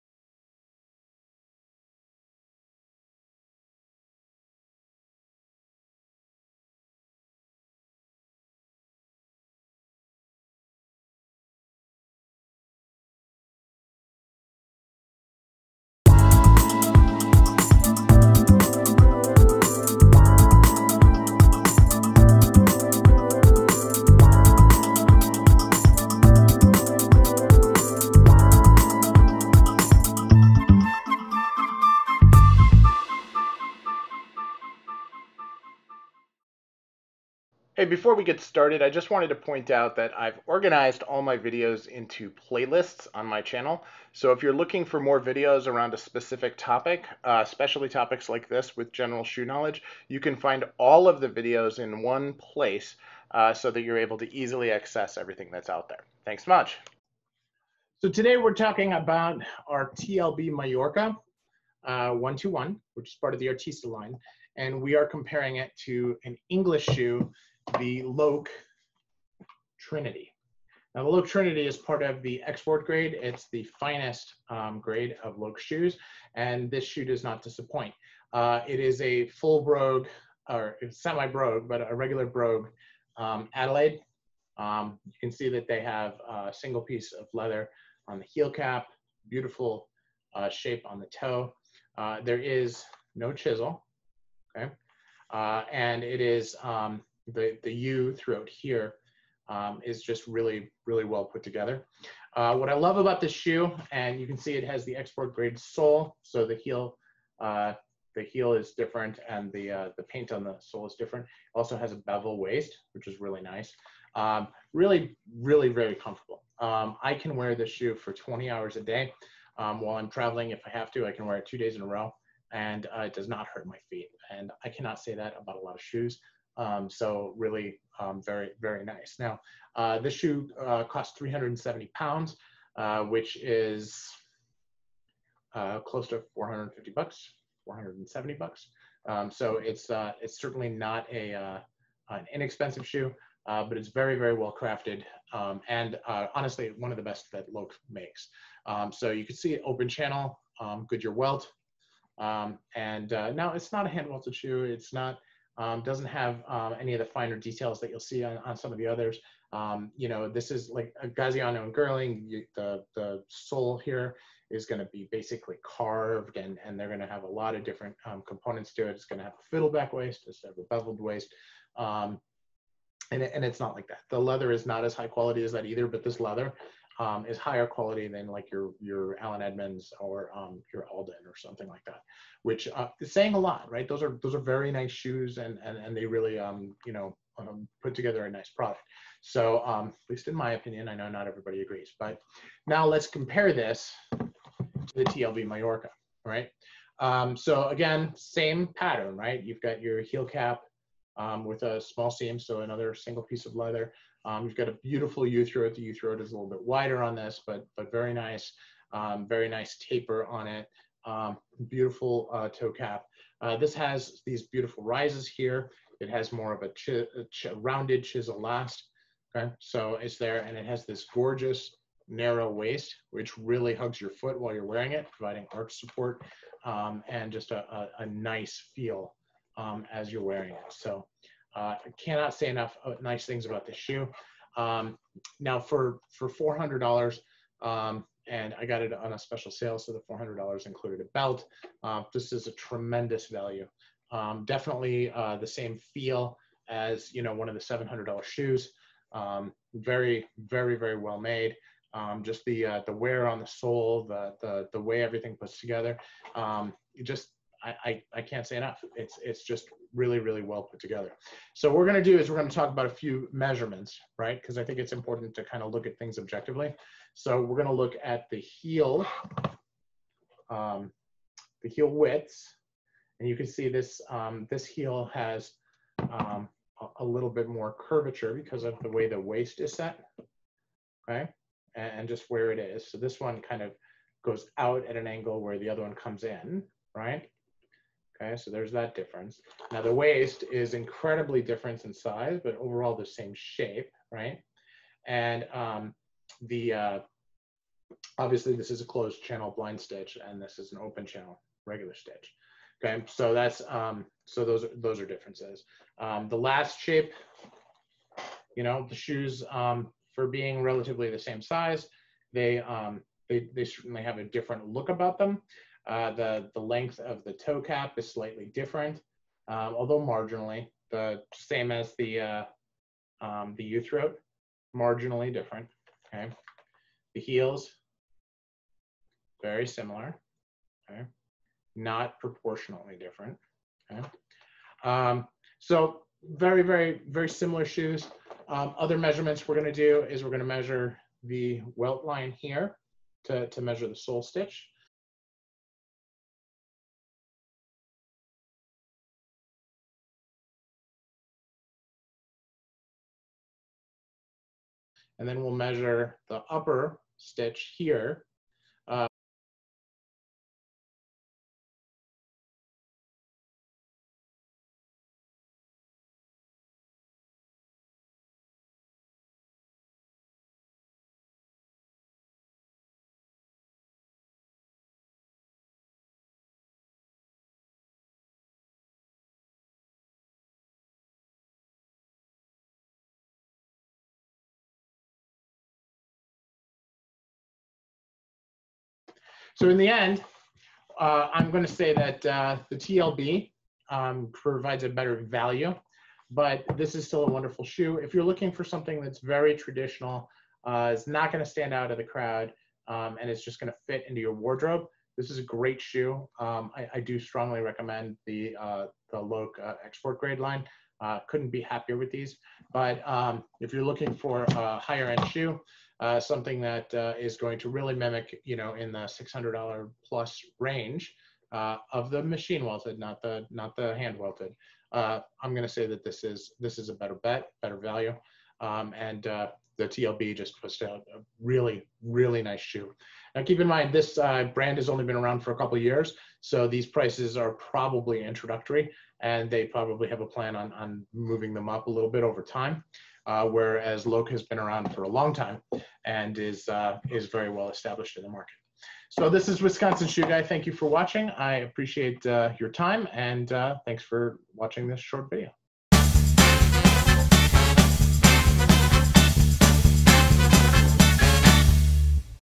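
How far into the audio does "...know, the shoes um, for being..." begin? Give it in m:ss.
5:08.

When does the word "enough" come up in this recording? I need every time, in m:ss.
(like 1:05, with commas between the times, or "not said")
3:52, 4:18.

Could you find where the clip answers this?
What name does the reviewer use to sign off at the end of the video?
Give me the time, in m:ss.
7:29.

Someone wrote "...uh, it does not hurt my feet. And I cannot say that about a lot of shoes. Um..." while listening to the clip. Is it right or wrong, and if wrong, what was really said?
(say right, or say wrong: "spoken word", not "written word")
right.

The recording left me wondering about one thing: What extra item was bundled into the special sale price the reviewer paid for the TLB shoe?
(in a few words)
a belt.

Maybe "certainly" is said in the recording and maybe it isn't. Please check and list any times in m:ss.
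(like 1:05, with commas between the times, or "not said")
2:20, 5:13.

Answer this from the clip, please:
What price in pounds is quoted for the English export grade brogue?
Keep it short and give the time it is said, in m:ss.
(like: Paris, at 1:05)
370 pounds, at 2:11.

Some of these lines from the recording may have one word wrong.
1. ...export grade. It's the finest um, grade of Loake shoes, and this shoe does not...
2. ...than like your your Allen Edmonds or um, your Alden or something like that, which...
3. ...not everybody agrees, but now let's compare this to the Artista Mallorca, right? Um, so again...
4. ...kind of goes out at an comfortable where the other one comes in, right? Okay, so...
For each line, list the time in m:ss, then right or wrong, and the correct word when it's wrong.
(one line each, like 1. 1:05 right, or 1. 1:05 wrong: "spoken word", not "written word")
1. 1:12 right
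2. 2:58 right
3. 3:11 wrong: "TLB", not "Artista"
4. 4:43 wrong: "angle", not "comfortable".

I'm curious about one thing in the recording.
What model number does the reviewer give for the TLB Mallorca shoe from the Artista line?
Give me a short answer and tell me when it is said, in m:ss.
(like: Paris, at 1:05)
121, at 1:02.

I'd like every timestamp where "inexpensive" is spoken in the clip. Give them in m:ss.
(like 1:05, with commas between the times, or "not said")
2:22.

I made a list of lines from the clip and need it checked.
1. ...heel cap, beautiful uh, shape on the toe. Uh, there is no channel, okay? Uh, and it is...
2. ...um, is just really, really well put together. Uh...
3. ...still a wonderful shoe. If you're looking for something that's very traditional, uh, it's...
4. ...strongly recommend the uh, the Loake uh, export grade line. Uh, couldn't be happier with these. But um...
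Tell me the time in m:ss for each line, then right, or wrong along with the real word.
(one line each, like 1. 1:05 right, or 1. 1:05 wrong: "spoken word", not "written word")
1. 1:28 wrong: "chisel", not "channel"
2. 1:39 right
3. 6:37 right
4. 6:47 right.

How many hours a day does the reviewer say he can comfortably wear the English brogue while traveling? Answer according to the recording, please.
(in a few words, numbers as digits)
20.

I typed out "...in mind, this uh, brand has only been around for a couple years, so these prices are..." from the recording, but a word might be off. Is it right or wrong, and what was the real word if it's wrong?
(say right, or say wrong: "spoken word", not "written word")
right.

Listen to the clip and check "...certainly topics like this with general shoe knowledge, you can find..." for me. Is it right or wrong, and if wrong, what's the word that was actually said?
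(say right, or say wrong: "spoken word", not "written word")
wrong: "especially", not "certainly".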